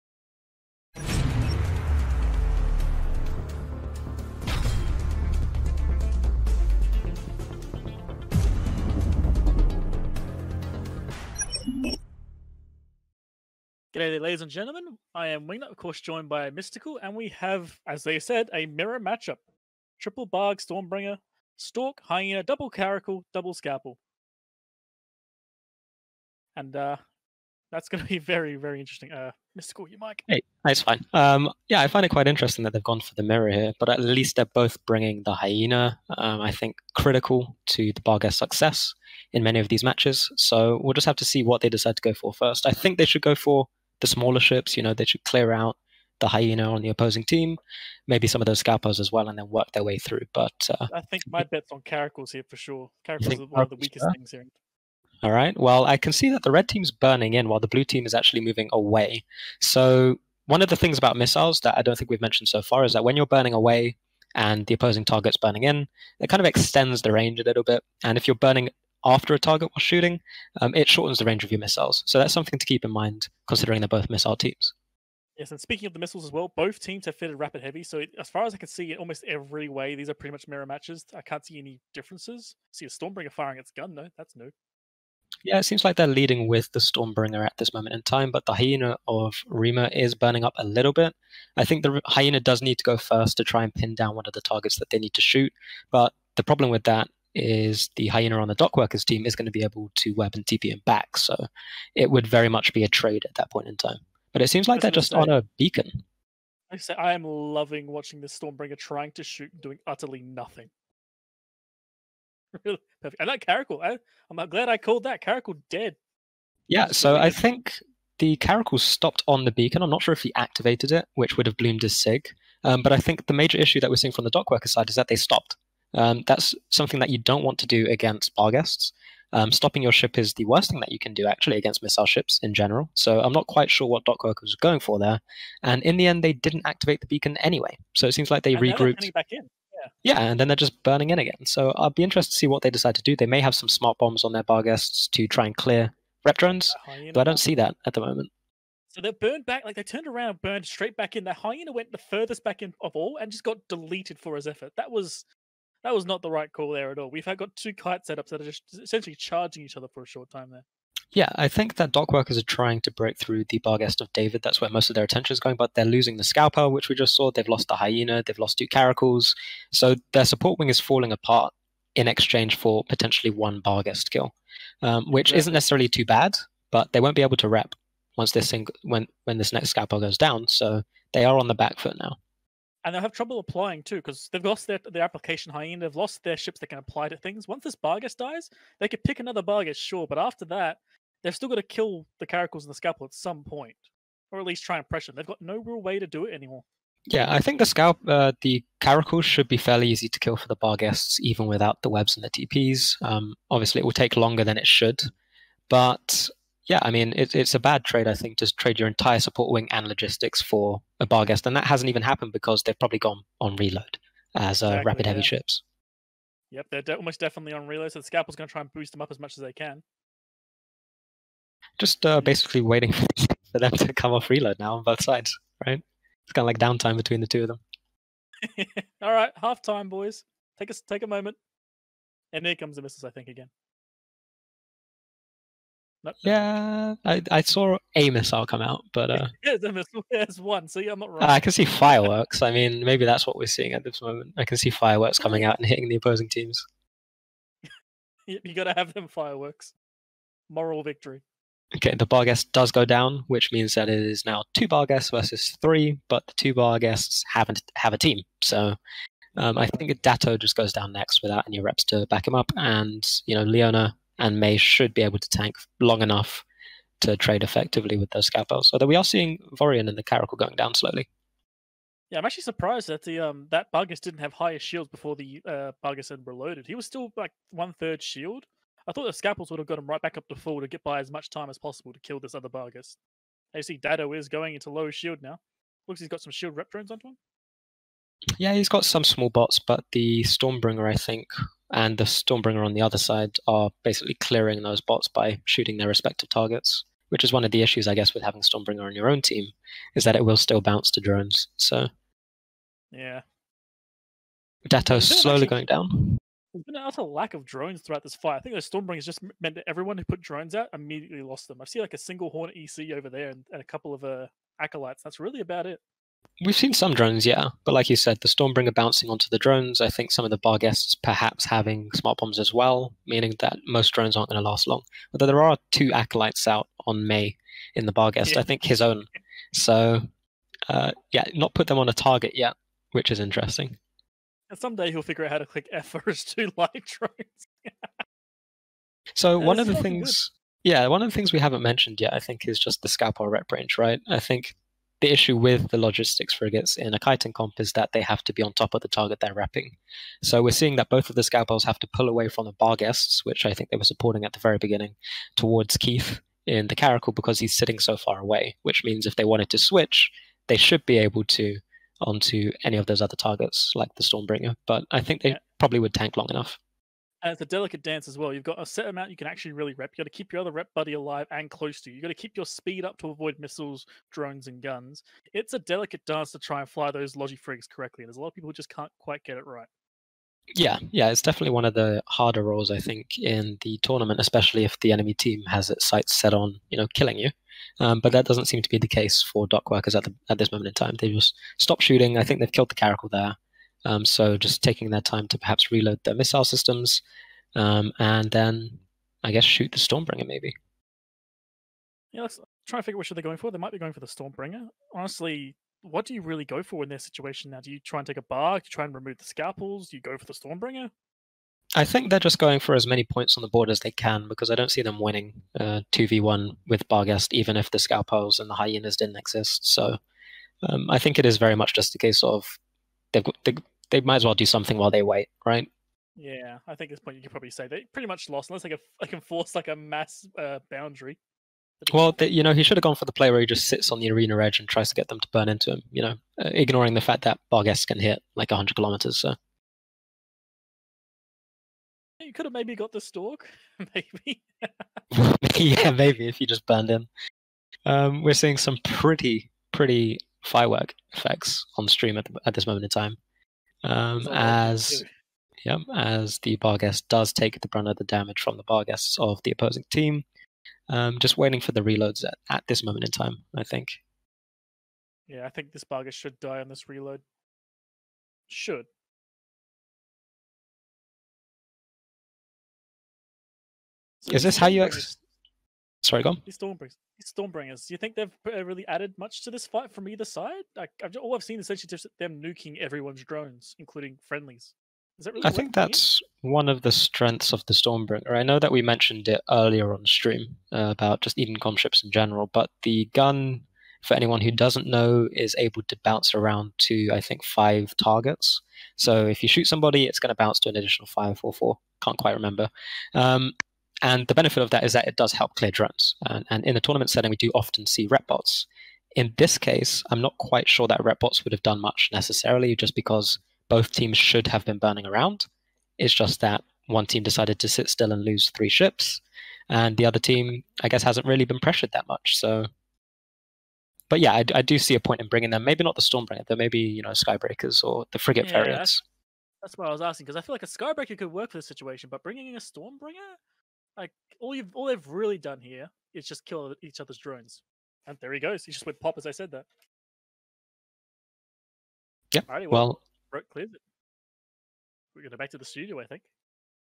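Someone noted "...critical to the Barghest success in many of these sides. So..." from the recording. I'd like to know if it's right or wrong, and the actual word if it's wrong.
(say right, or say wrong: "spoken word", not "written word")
wrong: "matches", not "sides".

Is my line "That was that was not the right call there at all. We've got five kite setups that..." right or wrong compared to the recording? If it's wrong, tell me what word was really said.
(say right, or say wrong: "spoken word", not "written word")
wrong: "two", not "five".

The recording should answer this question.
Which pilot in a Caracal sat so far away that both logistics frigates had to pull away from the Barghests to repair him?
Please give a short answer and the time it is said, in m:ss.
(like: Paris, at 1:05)
Keith, at 5:55.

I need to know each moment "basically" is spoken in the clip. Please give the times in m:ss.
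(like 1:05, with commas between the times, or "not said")
3:42, 4:53.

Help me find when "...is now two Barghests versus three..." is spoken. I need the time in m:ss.
4:13.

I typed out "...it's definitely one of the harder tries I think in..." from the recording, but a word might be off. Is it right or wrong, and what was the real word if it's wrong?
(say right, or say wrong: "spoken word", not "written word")
wrong: "roles", not "tries".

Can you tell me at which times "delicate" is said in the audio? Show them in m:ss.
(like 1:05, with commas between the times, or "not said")
6:07, 6:15.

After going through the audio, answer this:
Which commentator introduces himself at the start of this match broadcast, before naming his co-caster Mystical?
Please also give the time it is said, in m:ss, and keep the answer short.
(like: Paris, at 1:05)
Wingnut, at 0:15.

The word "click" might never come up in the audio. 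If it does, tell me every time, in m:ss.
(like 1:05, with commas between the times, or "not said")
5:35.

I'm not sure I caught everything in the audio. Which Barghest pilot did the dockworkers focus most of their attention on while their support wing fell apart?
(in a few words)
David.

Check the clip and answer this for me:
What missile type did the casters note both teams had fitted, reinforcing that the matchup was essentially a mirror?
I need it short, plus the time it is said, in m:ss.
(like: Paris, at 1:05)
Rapid heavy, at 1:17.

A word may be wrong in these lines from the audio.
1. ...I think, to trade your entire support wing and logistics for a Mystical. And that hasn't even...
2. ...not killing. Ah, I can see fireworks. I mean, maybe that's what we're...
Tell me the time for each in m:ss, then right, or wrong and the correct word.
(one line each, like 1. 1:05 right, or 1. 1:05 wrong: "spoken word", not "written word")
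1. 3:28 wrong: "Barghest", not "Mystical"
2. 4:00 wrong: "wrong", not "killing".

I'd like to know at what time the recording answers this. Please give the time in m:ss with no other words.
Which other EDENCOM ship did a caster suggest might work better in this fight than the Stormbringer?
8:47.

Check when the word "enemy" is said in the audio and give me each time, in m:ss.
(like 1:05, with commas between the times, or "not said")
6:24.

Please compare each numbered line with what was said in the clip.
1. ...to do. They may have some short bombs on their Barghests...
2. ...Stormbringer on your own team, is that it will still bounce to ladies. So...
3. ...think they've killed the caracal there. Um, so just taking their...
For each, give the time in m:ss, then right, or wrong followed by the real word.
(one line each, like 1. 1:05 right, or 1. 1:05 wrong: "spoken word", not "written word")
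1. 2:22 wrong: "smart", not "short"
2. 4:58 wrong: "drones", not "ladies"
3. 6:32 right.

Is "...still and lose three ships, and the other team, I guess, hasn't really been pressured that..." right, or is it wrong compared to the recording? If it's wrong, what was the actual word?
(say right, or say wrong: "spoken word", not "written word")
right.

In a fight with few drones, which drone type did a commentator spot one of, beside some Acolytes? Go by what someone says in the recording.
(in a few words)
Hornet EC.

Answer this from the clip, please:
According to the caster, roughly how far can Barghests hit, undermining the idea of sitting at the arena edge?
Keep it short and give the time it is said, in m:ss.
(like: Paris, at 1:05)
100 kilometers, at 7:18.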